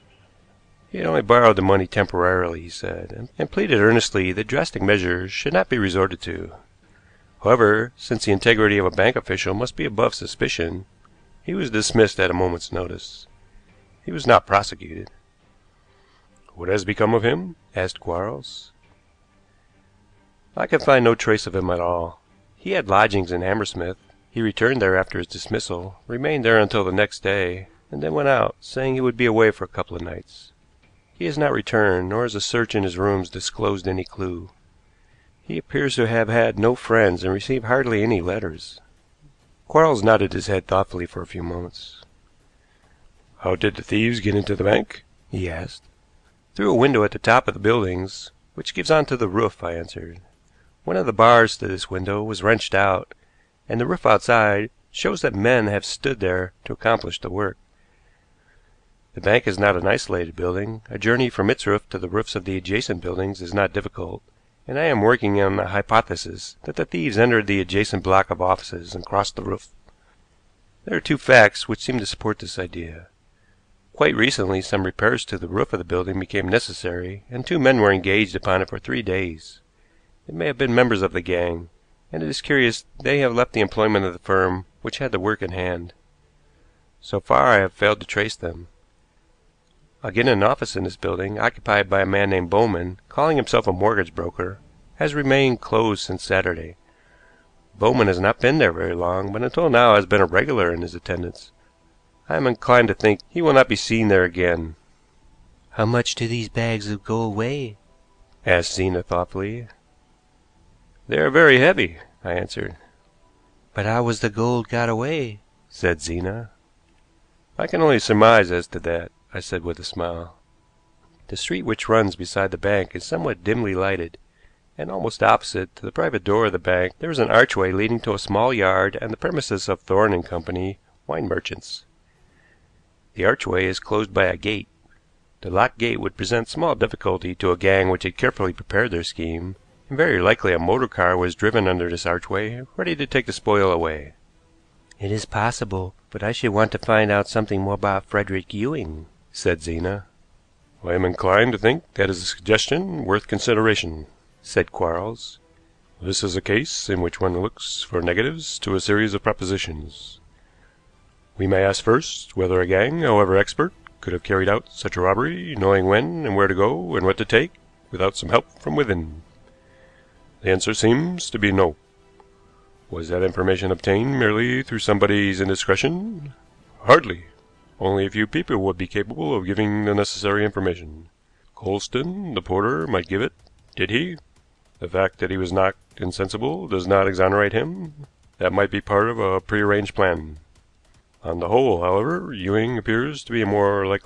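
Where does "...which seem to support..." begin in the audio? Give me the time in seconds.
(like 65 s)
71 s.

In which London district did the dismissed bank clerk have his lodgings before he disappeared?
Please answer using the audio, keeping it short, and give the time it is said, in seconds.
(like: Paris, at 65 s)
Hammersmith, at 23 s.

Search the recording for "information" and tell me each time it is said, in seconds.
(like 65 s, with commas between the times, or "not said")
173 s, 180 s.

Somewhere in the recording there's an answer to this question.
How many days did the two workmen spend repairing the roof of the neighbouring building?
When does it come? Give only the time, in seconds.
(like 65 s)
78 s.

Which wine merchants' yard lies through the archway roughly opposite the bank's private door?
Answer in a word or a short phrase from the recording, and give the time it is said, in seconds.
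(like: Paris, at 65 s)
Thorne and Co., at 129 s.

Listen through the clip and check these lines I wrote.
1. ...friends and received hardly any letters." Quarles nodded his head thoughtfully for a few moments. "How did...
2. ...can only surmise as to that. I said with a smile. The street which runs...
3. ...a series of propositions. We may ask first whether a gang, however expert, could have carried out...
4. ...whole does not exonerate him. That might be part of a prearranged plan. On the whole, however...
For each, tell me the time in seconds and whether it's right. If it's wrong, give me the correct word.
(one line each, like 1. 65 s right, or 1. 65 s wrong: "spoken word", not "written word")
1. 36 s right
2. 117 s right
3. 158 s right
4. 185 s wrong: "insensible", not "whole".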